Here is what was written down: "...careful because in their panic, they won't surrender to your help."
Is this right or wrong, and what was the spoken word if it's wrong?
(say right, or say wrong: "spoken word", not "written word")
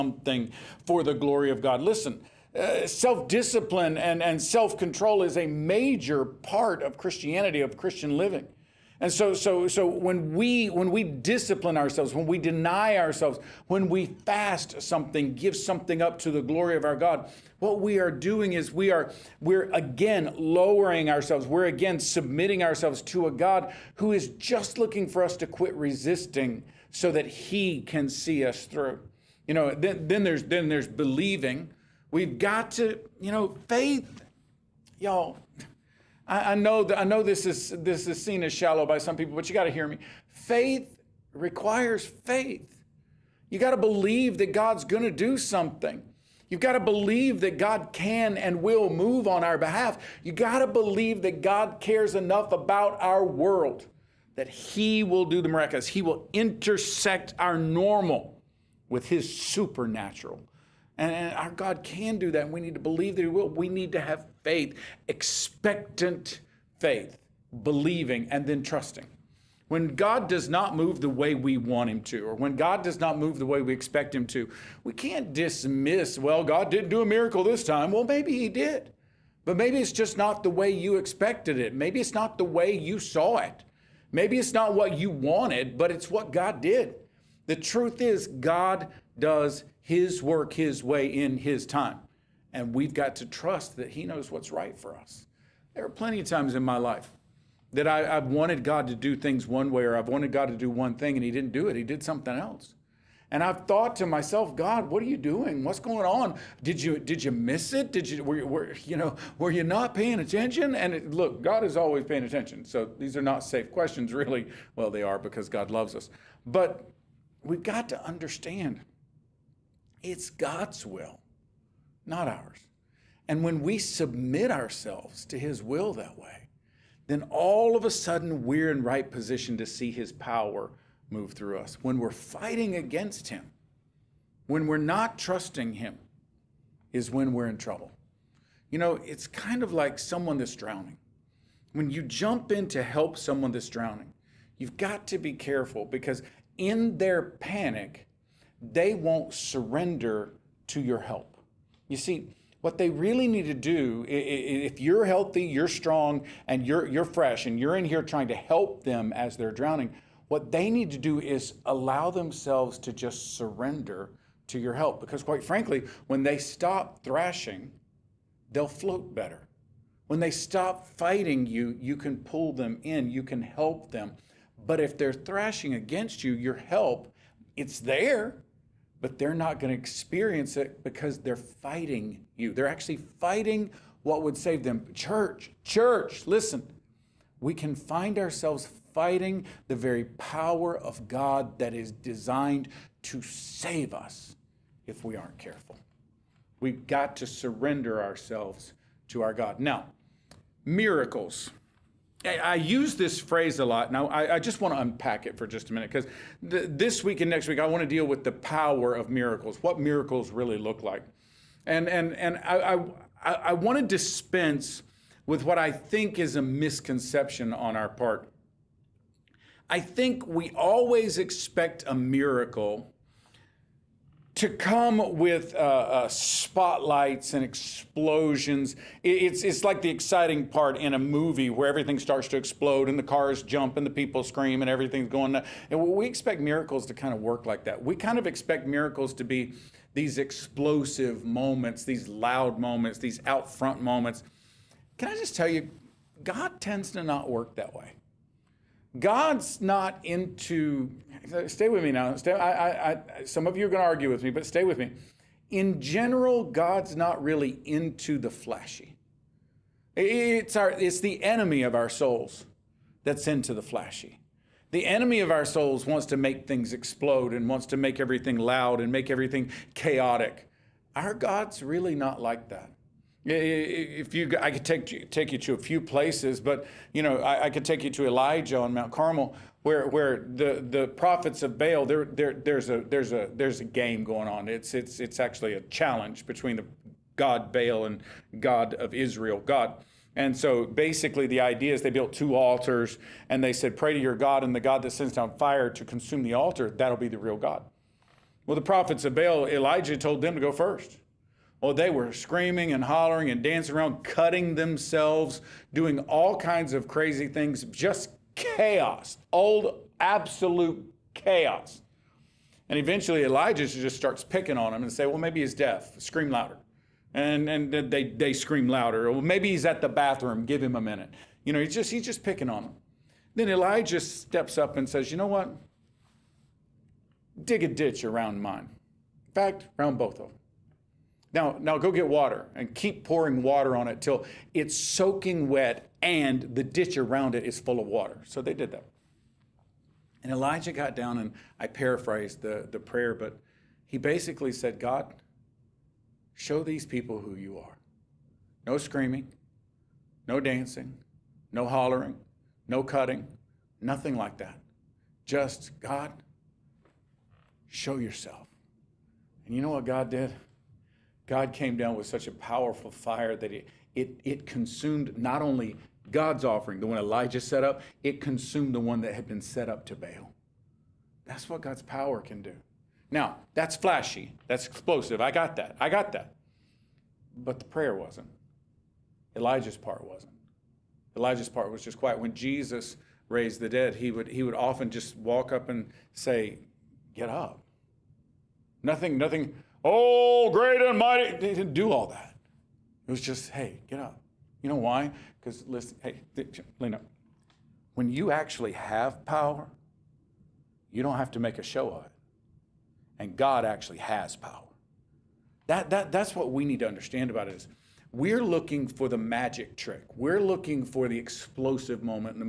right.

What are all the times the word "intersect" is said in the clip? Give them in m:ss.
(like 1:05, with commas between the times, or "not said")
0:56.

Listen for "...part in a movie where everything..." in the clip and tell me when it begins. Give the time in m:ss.
3:50.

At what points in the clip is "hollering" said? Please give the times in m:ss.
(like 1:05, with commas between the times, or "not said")
5:02, 5:51.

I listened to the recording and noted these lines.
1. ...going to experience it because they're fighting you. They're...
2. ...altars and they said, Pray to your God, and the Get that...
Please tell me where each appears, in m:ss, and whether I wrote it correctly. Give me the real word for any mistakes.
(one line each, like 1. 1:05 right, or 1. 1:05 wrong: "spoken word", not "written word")
1. 2:59 right
2. 4:52 wrong: "God", not "Get".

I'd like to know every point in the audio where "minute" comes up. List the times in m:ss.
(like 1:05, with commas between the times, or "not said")
3:25, 5:20.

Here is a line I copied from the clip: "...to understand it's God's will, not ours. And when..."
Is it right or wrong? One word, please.
right.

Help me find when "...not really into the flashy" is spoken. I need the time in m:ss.
4:16.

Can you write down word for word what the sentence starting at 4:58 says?
Well, the prophets of Baal, Elijah told them to go first.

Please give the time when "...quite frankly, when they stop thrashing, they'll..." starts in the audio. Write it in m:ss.
2:45.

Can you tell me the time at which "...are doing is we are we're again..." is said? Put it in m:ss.
0:17.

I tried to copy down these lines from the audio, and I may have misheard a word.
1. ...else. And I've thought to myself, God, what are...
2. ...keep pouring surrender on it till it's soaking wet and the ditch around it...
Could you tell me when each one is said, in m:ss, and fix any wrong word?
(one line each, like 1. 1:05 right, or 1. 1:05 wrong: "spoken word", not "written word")
1. 1:42 right
2. 5:32 wrong: "water", not "surrender".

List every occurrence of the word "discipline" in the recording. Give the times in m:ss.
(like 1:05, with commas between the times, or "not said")
0:03, 0:11.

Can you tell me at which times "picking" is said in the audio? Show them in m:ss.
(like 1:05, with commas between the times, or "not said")
5:14, 5:22.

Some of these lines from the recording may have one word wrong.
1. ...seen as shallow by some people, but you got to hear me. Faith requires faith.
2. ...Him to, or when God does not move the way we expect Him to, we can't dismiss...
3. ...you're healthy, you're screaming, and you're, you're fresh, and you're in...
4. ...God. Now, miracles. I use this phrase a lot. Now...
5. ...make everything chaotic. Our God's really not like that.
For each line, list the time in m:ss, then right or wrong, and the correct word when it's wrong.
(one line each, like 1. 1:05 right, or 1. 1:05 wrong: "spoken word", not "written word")
1. 0:38 right
2. 1:11 right
3. 2:34 wrong: "strong", not "screaming"
4. 3:19 right
5. 4:28 right.